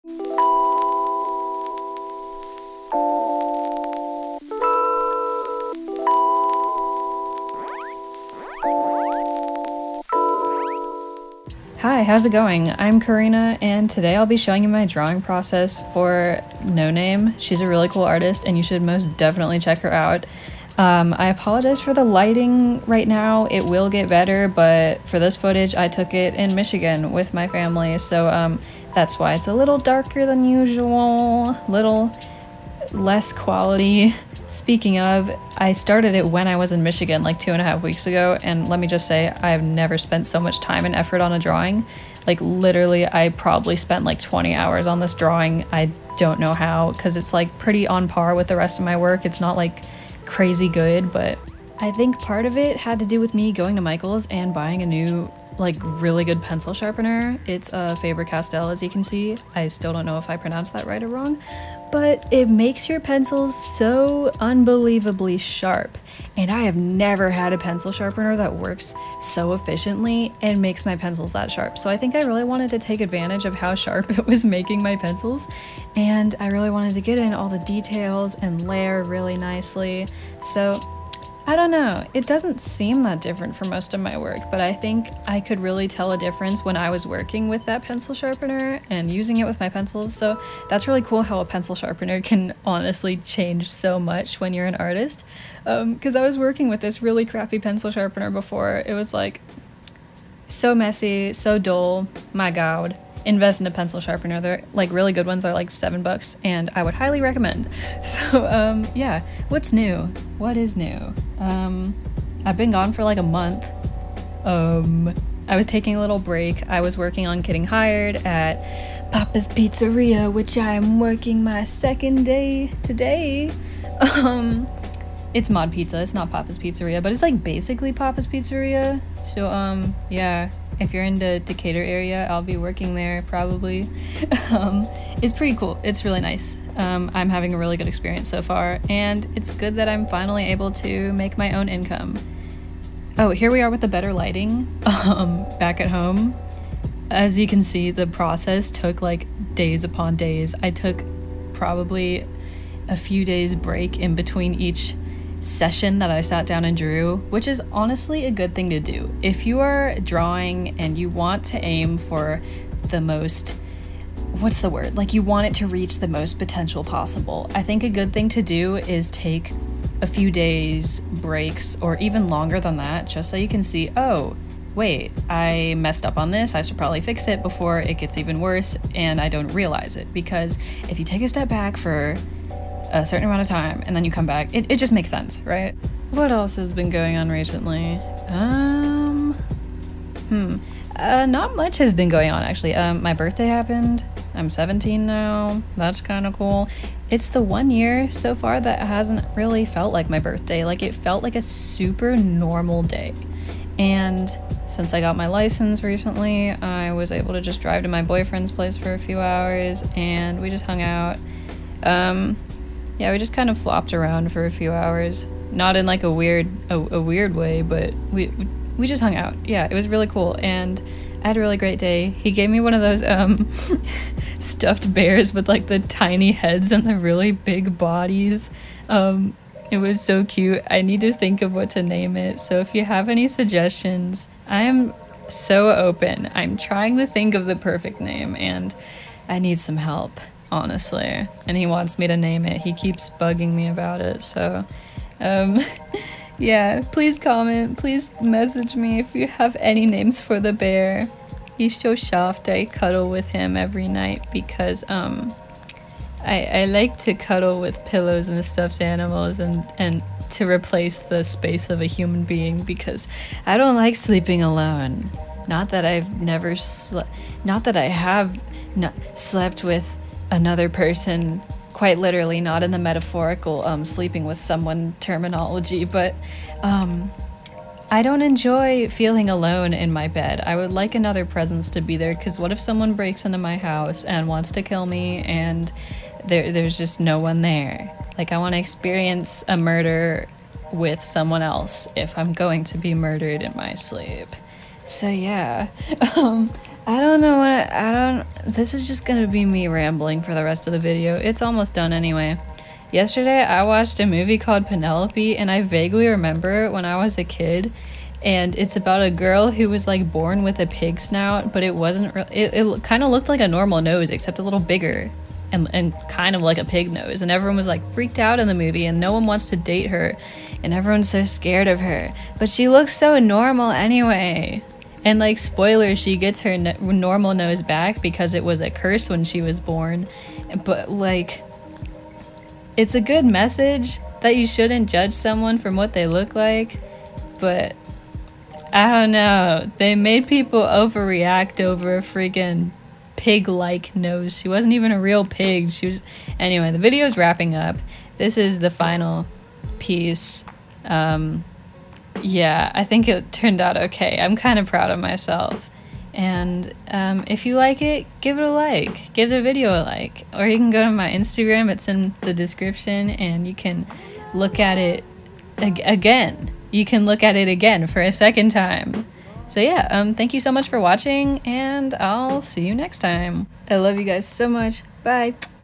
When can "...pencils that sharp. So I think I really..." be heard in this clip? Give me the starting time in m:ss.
1:10.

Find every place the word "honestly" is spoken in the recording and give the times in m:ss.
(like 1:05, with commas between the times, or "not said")
1:32, 2:37, 4:00.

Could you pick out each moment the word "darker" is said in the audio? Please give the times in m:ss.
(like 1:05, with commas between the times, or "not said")
0:29.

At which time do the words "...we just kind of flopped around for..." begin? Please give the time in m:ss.
3:33.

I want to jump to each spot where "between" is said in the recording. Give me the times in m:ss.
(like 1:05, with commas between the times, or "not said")
2:34.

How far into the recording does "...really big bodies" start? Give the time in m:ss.
3:46.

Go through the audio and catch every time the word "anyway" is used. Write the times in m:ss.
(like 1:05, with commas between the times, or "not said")
5:01, 5:23, 5:46.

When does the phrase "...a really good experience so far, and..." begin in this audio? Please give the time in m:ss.
2:17.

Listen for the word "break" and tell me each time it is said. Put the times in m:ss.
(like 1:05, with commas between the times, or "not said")
1:56, 2:33, 2:51, 4:42.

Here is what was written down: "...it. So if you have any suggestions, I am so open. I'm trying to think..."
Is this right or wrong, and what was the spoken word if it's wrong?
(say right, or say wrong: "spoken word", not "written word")
right.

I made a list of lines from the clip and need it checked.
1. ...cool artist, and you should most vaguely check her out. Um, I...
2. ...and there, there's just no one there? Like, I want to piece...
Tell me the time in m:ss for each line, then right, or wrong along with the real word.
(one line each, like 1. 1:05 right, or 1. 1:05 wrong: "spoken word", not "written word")
1. 0:17 wrong: "definitely", not "vaguely"
2. 4:45 wrong: "experience", not "piece".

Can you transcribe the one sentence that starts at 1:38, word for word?
It was like so messy, so dull.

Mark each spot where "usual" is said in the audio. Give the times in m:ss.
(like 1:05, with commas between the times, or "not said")
0:30.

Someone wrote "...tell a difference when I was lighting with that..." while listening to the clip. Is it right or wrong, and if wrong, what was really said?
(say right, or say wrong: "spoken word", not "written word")
wrong: "working", not "lighting".